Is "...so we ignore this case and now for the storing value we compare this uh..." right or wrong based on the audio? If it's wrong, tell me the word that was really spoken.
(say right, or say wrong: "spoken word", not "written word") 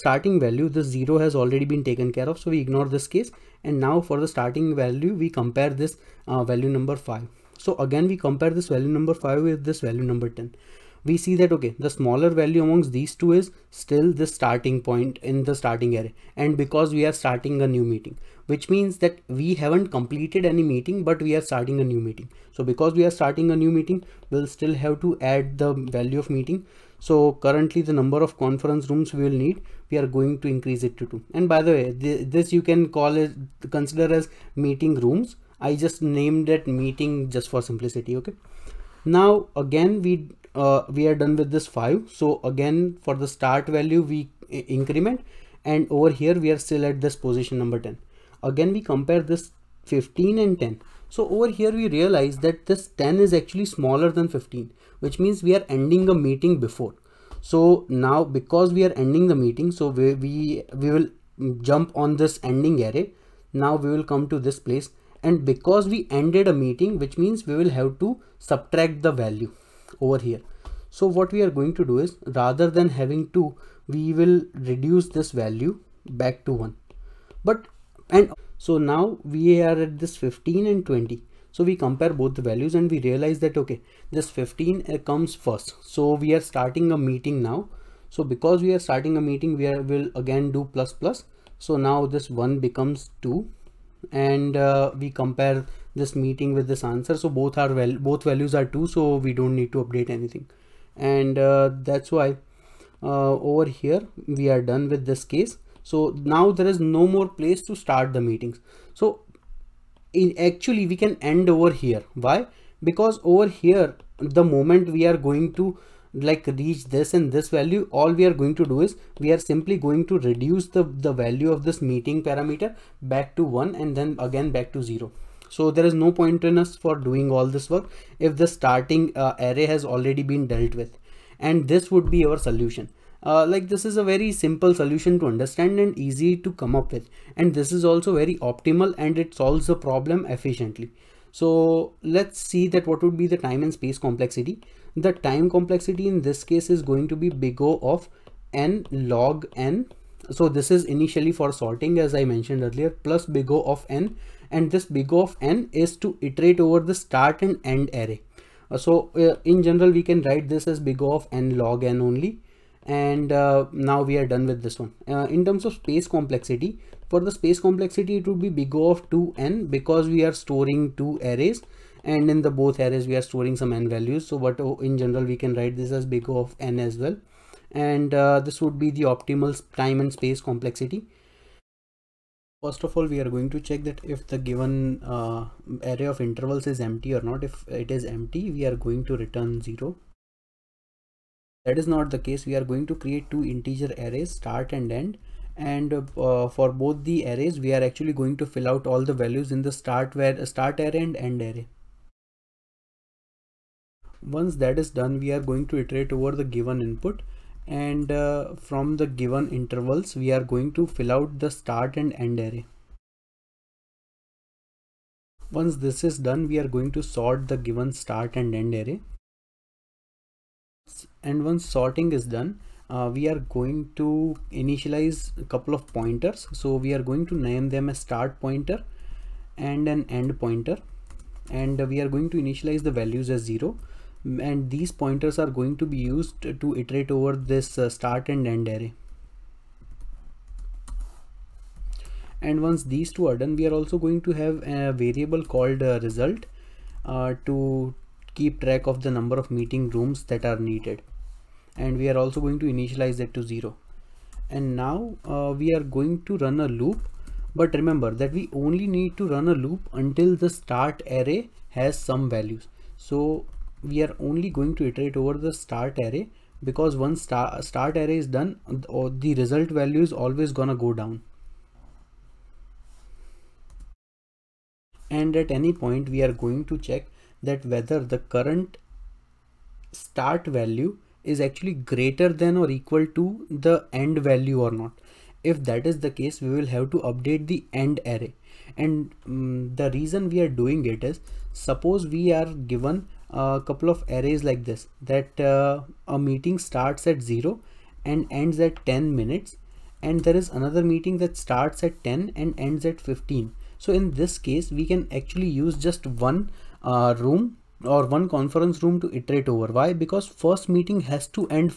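wrong: "starting", not "storing".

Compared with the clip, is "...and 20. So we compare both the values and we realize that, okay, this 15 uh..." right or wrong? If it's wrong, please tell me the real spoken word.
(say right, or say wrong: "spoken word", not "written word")
right.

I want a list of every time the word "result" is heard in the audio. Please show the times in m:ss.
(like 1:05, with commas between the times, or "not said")
4:06, 4:29.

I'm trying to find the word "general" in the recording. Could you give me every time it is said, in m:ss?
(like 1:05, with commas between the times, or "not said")
2:39, 2:54.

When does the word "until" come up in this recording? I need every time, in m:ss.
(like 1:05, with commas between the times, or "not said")
4:19.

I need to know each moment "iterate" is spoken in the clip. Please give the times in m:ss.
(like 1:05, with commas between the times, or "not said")
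2:36, 3:25, 3:56, 4:24, 5:09.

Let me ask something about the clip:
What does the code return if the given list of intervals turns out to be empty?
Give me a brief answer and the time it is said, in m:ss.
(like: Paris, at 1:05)
0, at 3:09.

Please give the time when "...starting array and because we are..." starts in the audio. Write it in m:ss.
0:15.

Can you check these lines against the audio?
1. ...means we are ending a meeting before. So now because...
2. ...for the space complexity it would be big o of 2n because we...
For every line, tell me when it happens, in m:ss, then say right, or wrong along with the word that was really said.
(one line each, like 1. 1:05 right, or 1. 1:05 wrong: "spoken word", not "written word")
1. 0:55 right
2. 2:47 right.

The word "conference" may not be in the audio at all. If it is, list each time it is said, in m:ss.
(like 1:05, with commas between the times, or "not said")
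0:28, 5:08.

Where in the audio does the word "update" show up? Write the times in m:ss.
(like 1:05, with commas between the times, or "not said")
1:39, 4:47.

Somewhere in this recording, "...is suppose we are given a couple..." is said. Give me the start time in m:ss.
4:51.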